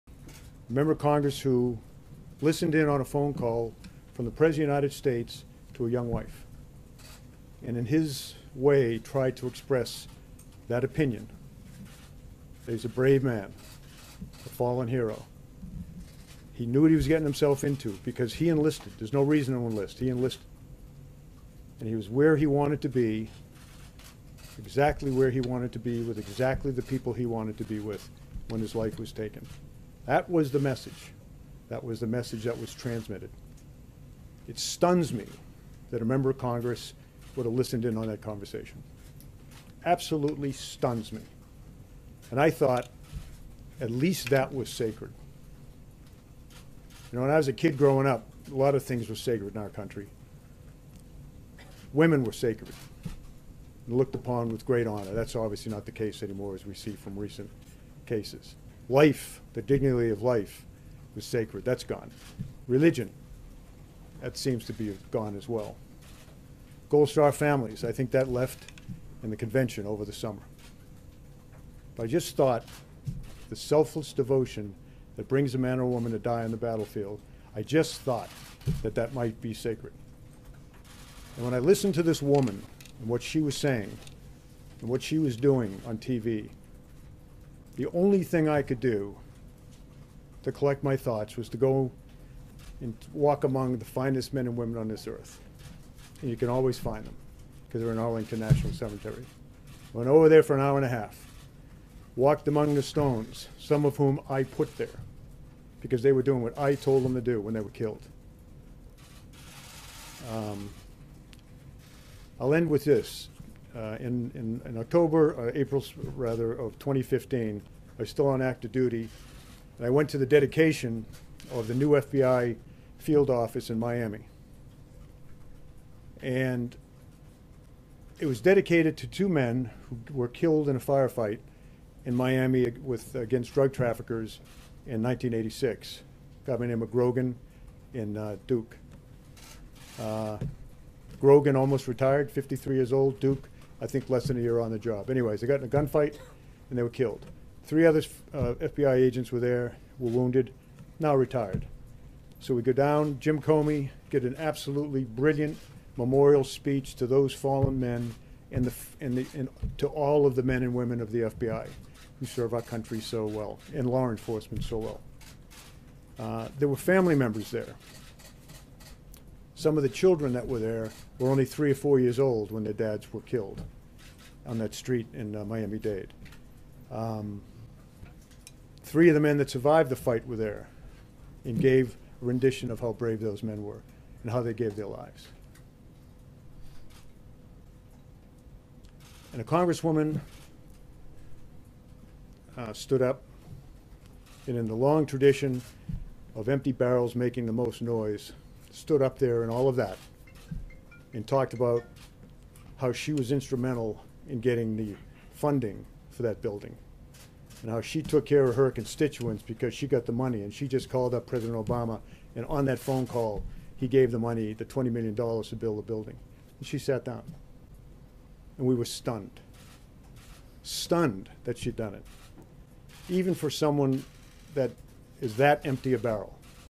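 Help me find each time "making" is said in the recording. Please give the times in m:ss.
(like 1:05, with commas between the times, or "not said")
3:17.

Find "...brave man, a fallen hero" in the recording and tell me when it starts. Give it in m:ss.
0:12.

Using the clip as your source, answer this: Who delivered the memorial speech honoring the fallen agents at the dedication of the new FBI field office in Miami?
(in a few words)
Jim Comey.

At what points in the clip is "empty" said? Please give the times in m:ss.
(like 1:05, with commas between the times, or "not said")
3:16, 3:45.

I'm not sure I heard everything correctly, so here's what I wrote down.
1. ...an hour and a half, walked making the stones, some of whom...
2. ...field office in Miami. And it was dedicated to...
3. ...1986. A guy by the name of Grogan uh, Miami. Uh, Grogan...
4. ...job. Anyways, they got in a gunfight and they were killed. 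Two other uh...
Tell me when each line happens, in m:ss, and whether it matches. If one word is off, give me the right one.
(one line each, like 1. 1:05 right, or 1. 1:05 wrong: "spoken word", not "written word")
1. 1:40 wrong: "among", not "making"
2. 2:02 right
3. 2:15 wrong: "Duke", not "Miami"
4. 2:24 wrong: "Three", not "Two".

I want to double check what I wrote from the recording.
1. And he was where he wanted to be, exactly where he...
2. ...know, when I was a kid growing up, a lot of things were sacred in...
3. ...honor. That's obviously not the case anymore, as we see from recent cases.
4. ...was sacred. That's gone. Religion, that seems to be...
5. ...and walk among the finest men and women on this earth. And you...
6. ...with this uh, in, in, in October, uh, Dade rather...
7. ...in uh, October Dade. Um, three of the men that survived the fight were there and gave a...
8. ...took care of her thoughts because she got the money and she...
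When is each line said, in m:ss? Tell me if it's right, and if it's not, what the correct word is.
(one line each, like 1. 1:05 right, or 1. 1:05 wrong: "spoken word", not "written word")
1. 0:21 right
2. 0:47 right
3. 0:54 right
4. 1:01 right
5. 1:32 right
6. 1:52 wrong: "April", not "Dade"
7. 2:55 wrong: "Miami", not "October"
8. 3:28 wrong: "constituents", not "thoughts".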